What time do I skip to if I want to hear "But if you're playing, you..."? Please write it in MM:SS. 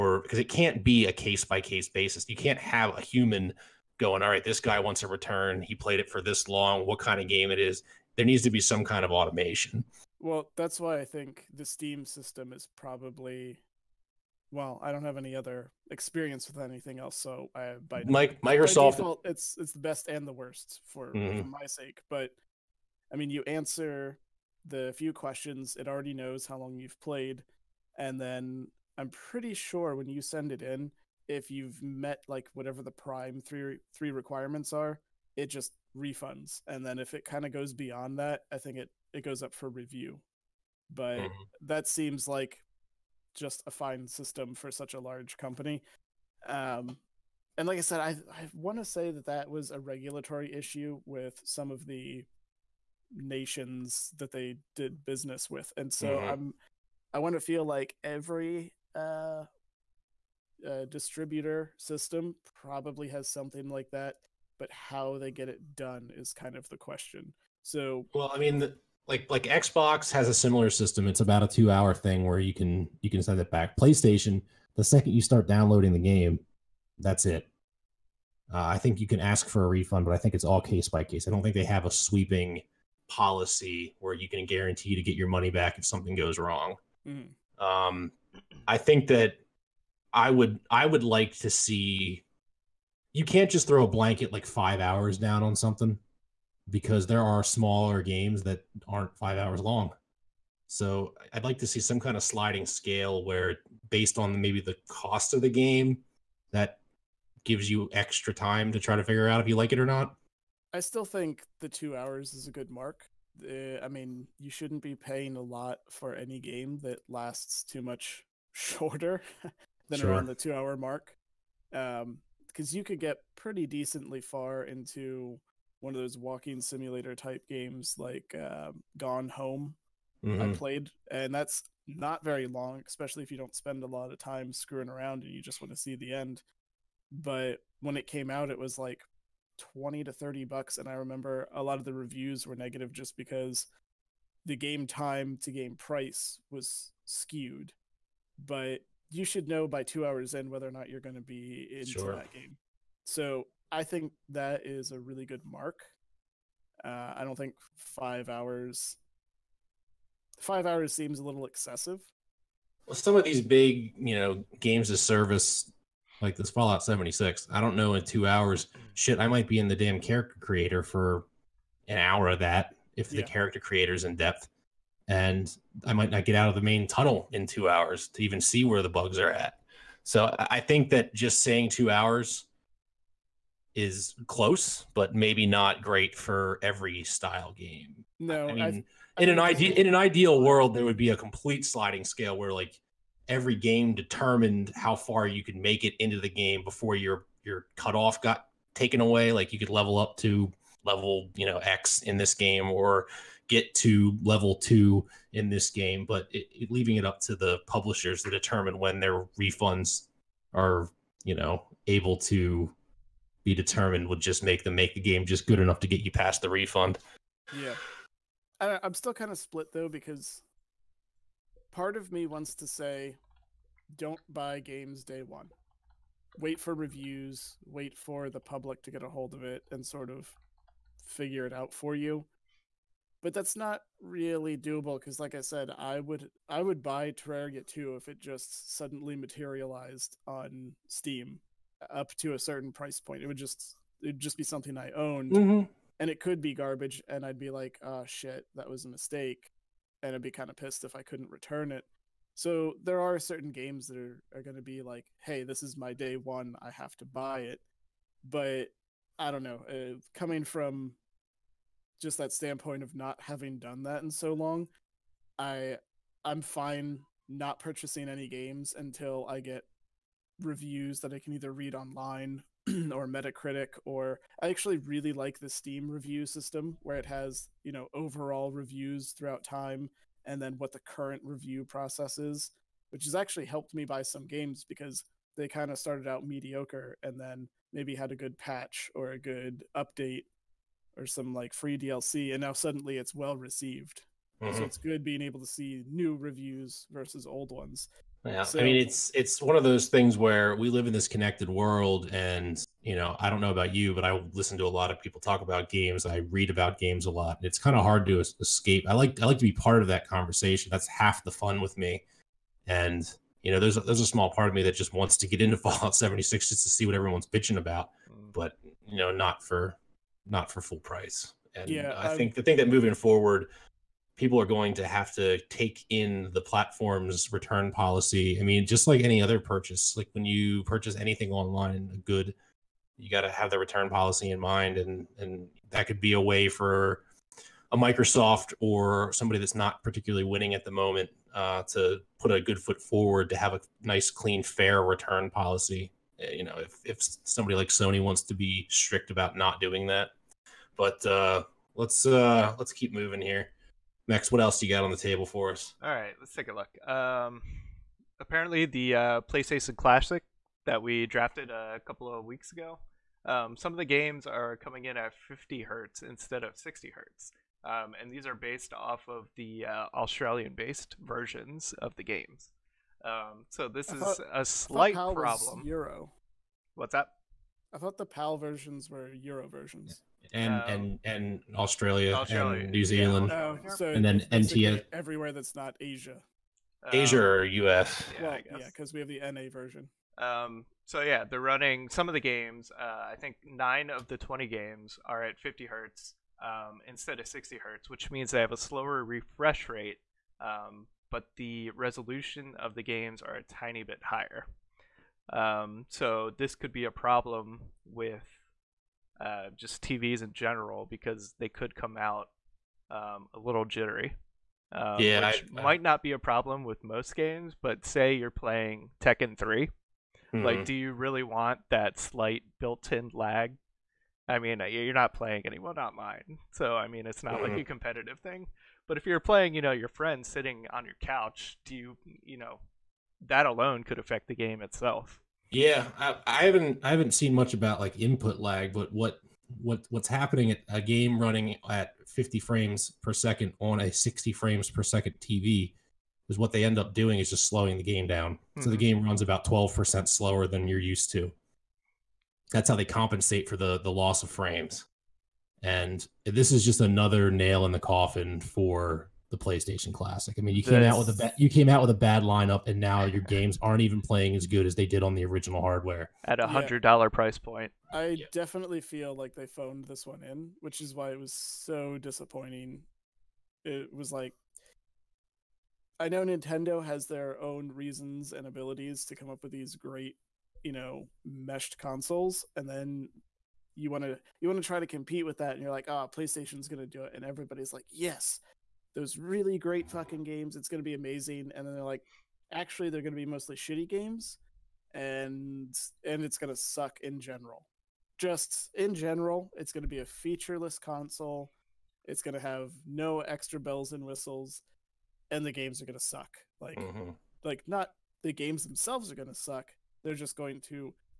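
07:08.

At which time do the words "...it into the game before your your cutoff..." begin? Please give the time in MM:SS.
03:15.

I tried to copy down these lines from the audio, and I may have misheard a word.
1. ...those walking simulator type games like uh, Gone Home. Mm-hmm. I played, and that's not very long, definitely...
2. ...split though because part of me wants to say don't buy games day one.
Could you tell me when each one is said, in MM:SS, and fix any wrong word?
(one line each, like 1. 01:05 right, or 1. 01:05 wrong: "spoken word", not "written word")
1. 02:06 wrong: "especially", not "definitely"
2. 03:39 right.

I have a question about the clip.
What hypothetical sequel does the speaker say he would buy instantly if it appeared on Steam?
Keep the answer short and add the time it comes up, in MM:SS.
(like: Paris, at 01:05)
Terraria 2, at 03:57.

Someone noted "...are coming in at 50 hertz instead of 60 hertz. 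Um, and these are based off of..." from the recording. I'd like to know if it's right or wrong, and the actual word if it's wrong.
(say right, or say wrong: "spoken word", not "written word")
right.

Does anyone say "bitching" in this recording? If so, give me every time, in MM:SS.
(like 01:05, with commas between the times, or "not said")
05:17.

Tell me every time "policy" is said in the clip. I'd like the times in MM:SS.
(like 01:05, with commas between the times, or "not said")
01:23, 05:27, 05:33, 05:45.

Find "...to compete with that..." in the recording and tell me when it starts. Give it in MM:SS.
08:04.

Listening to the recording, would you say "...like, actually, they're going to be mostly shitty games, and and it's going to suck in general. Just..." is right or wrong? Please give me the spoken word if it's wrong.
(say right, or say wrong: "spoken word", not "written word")
right.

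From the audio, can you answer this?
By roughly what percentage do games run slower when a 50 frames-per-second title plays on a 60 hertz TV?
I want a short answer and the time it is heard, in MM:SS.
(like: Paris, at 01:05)
12%, at 07:29.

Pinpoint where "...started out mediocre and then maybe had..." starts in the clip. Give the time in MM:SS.
04:45.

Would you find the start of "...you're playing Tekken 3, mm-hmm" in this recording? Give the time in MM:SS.
06:58.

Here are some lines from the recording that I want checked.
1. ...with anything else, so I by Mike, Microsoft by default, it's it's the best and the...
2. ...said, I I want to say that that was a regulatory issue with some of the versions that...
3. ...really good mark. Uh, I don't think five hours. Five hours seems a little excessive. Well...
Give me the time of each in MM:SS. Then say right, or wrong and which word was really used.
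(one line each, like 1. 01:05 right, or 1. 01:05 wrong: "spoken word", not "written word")
1. 00:16 right
2. 00:47 wrong: "nations", not "versions"
3. 02:35 right.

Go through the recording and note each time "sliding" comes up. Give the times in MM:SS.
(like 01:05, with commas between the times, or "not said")
01:42, 03:11.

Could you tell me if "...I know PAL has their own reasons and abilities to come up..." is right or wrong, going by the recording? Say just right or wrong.
wrong.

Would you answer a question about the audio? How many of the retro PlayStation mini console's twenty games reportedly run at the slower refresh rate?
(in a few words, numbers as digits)
9.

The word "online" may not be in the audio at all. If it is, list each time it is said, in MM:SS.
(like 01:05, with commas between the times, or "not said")
04:31, 05:31.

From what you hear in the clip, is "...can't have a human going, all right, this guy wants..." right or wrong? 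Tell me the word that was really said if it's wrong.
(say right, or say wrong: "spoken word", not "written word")
right.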